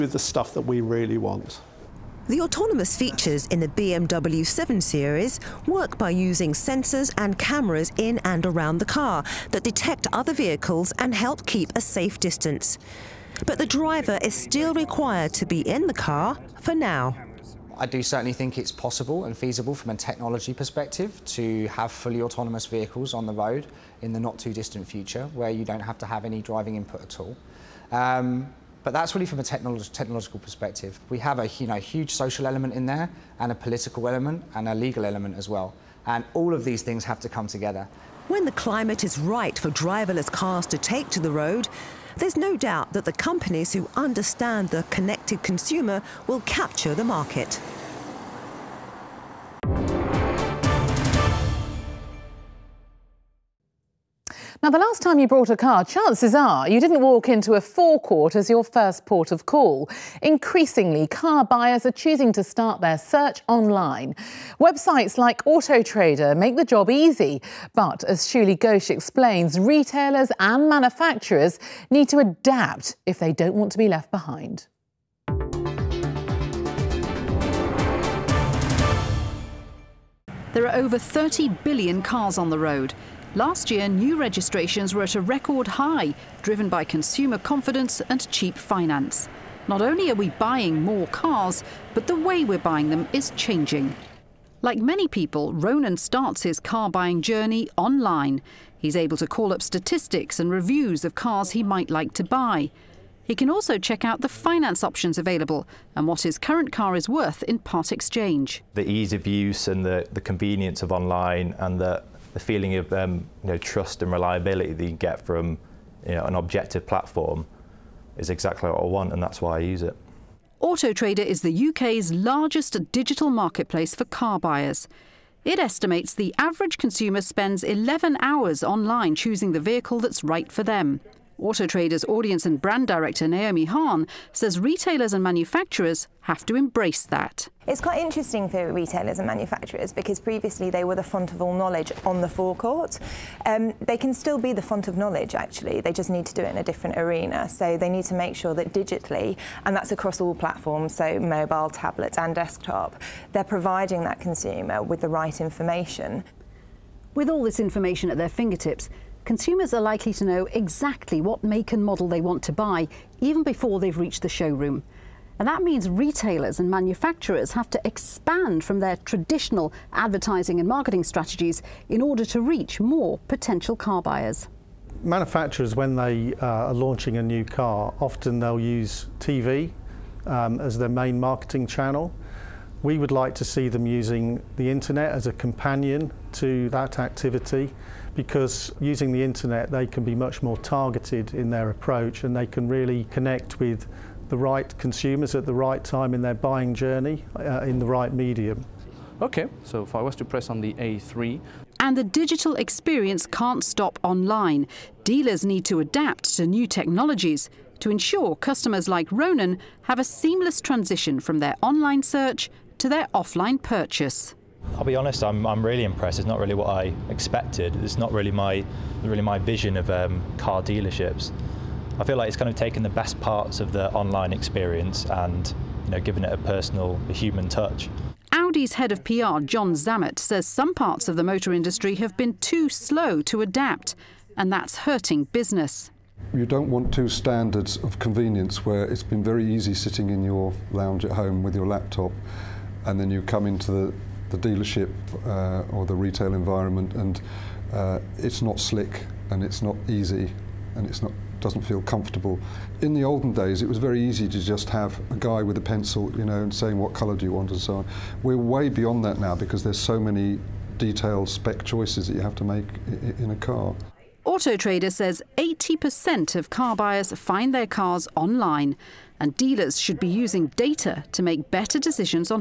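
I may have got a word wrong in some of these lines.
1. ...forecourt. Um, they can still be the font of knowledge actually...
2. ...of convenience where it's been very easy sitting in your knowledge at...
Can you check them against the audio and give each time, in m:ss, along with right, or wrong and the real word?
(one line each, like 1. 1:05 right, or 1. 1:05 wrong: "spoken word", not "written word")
1. 2:22 right
2. 3:57 wrong: "lounge", not "knowledge".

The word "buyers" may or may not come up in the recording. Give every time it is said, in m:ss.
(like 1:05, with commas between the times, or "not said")
1:01, 2:04, 2:53, 4:26.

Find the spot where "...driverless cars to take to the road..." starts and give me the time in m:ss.
0:39.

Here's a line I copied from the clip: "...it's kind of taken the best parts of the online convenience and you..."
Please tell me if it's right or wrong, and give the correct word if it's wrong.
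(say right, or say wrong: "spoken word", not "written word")
wrong: "experience", not "convenience".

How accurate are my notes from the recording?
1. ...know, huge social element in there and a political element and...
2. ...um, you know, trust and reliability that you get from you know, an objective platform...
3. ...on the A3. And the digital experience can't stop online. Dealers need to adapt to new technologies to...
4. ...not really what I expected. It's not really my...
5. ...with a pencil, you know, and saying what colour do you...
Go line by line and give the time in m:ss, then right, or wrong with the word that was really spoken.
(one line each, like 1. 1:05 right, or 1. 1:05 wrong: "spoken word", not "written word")
1. 0:31 right
2. 1:52 right
3. 3:20 right
4. 3:36 right
5. 4:15 right.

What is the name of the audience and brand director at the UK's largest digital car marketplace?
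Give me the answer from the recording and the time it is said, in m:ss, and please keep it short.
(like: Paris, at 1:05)
Naomi Hahn, at 2:13.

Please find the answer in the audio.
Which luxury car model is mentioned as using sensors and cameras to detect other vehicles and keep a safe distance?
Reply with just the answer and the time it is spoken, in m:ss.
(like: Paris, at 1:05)
BMW 7 Series, at 0:03.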